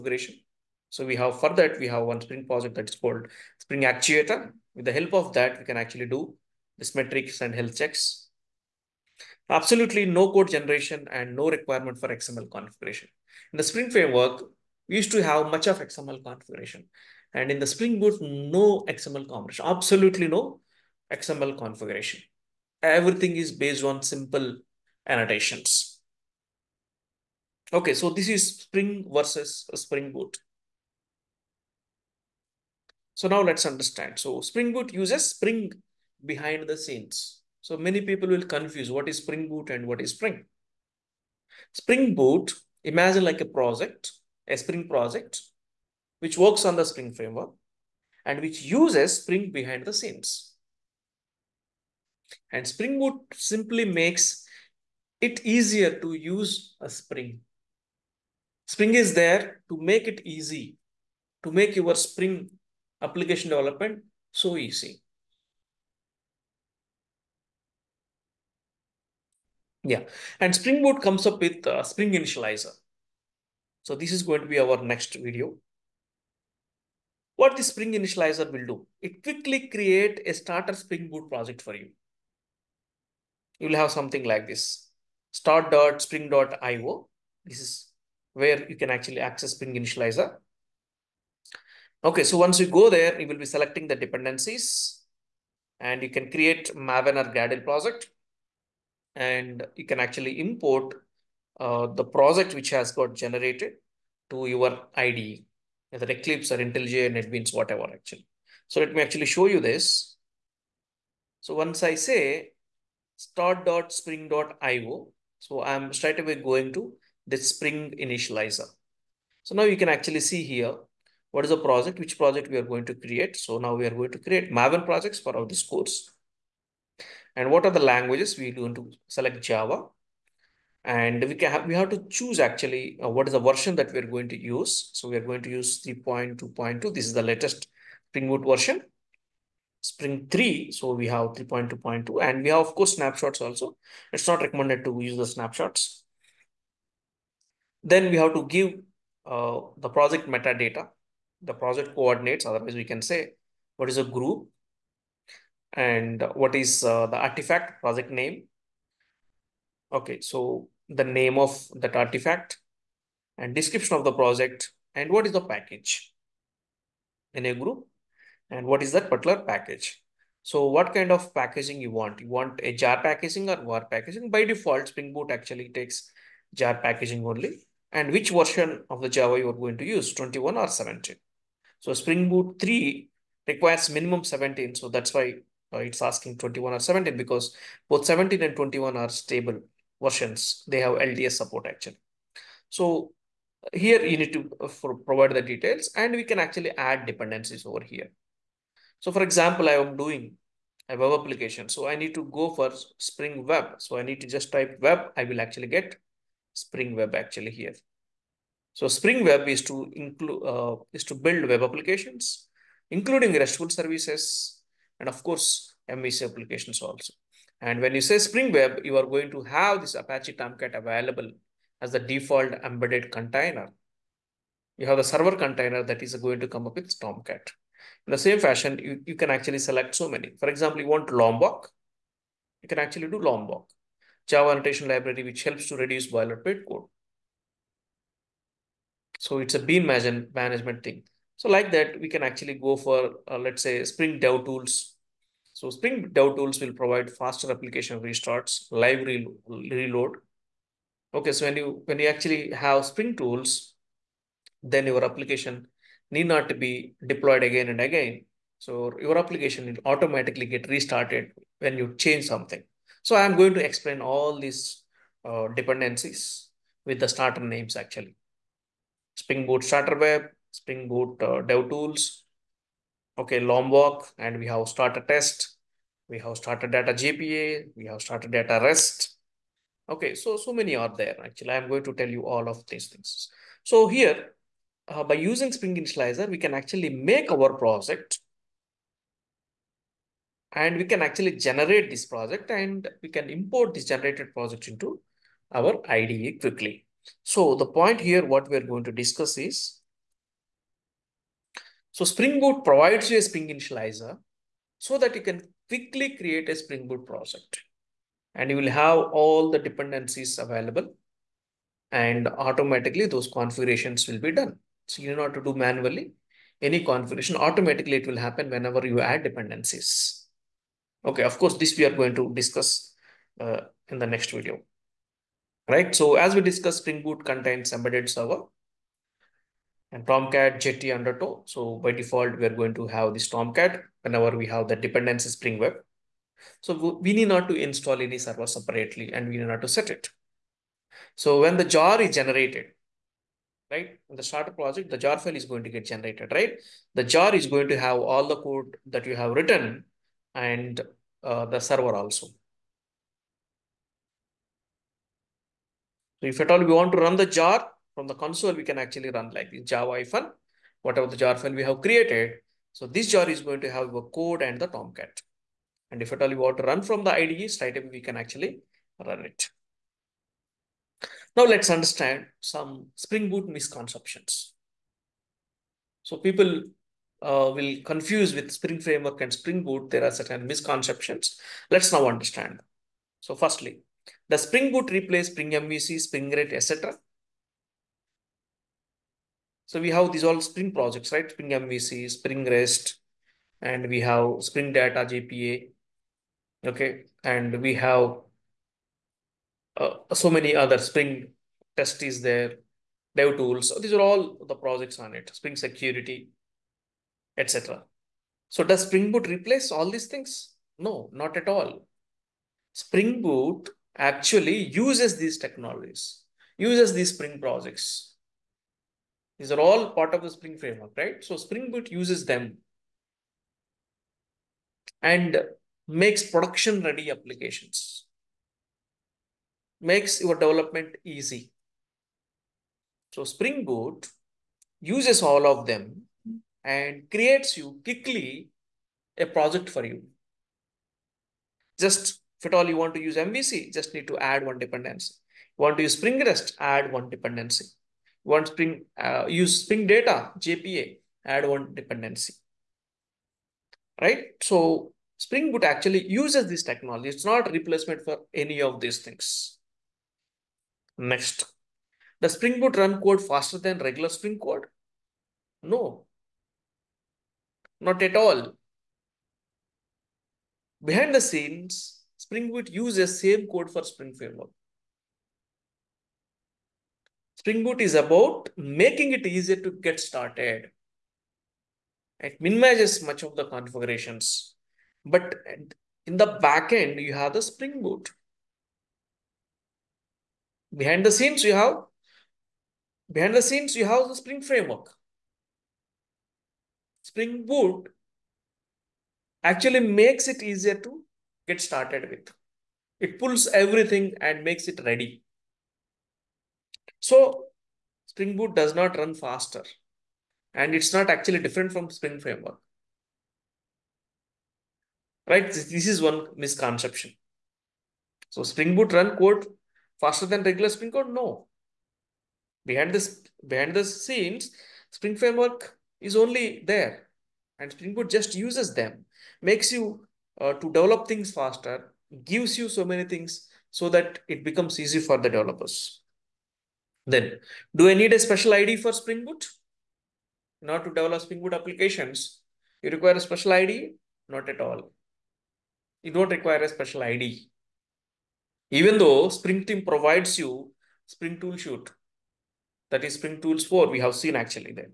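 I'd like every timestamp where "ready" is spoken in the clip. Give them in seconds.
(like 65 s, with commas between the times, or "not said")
426 s, 504 s.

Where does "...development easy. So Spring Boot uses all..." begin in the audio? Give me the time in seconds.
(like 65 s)
430 s.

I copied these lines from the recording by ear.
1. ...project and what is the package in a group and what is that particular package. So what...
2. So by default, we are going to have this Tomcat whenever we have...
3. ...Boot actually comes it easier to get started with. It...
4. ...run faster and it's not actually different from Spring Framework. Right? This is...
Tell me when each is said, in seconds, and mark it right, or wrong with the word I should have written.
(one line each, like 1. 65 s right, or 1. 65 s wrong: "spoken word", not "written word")
1. 164 s right
2. 331 s right
3. 497 s wrong: "makes", not "comes"
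4. 508 s right.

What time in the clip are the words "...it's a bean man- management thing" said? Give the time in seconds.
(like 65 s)
239 s.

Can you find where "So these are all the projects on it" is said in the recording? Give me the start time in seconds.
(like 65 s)
403 s.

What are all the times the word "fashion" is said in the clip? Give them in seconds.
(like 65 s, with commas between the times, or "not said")
228 s.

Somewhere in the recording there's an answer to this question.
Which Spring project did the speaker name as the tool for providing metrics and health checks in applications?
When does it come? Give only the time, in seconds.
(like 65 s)
3 s.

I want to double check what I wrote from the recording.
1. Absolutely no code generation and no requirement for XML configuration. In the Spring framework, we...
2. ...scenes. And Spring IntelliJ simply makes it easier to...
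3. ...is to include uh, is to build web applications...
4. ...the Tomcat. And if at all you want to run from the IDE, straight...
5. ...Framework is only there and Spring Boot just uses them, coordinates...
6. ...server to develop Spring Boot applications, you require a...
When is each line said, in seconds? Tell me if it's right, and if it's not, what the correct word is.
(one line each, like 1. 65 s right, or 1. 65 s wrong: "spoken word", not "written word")
1. 9 s right
2. 49 s wrong: "Boot", not "IntelliJ"
3. 209 s right
4. 364 s right
5. 525 s wrong: "makes", not "coordinates"
6. 540 s wrong: "order", not "server".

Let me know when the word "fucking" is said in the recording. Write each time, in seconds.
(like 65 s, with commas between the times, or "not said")
not said.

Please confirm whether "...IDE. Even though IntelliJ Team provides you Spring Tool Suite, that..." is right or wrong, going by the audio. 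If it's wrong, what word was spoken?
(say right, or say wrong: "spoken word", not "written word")
wrong: "Spring", not "IntelliJ".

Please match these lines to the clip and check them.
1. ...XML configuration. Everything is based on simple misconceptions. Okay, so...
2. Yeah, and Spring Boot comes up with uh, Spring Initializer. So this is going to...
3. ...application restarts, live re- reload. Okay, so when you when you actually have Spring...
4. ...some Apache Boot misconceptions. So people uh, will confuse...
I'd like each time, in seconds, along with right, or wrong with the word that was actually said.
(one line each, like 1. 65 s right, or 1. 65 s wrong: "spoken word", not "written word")
1. 21 s wrong: "annotations", not "misconceptions"
2. 69 s right
3. 247 s right
4. 372 s wrong: "Spring", not "Apache".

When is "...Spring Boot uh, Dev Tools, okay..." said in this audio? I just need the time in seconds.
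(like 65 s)
270 s.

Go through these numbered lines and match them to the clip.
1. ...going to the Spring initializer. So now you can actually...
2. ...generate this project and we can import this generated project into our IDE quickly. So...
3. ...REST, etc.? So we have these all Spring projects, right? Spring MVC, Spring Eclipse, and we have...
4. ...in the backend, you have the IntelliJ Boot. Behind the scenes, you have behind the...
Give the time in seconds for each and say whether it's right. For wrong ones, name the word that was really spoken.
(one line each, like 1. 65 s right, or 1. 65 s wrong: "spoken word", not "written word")
1. 116 s right
2. 291 s right
3. 386 s wrong: "REST", not "Eclipse"
4. 486 s wrong: "Spring", not "IntelliJ".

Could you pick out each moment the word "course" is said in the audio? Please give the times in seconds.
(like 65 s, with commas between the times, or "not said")
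125 s, 142 s, 215 s, 321 s.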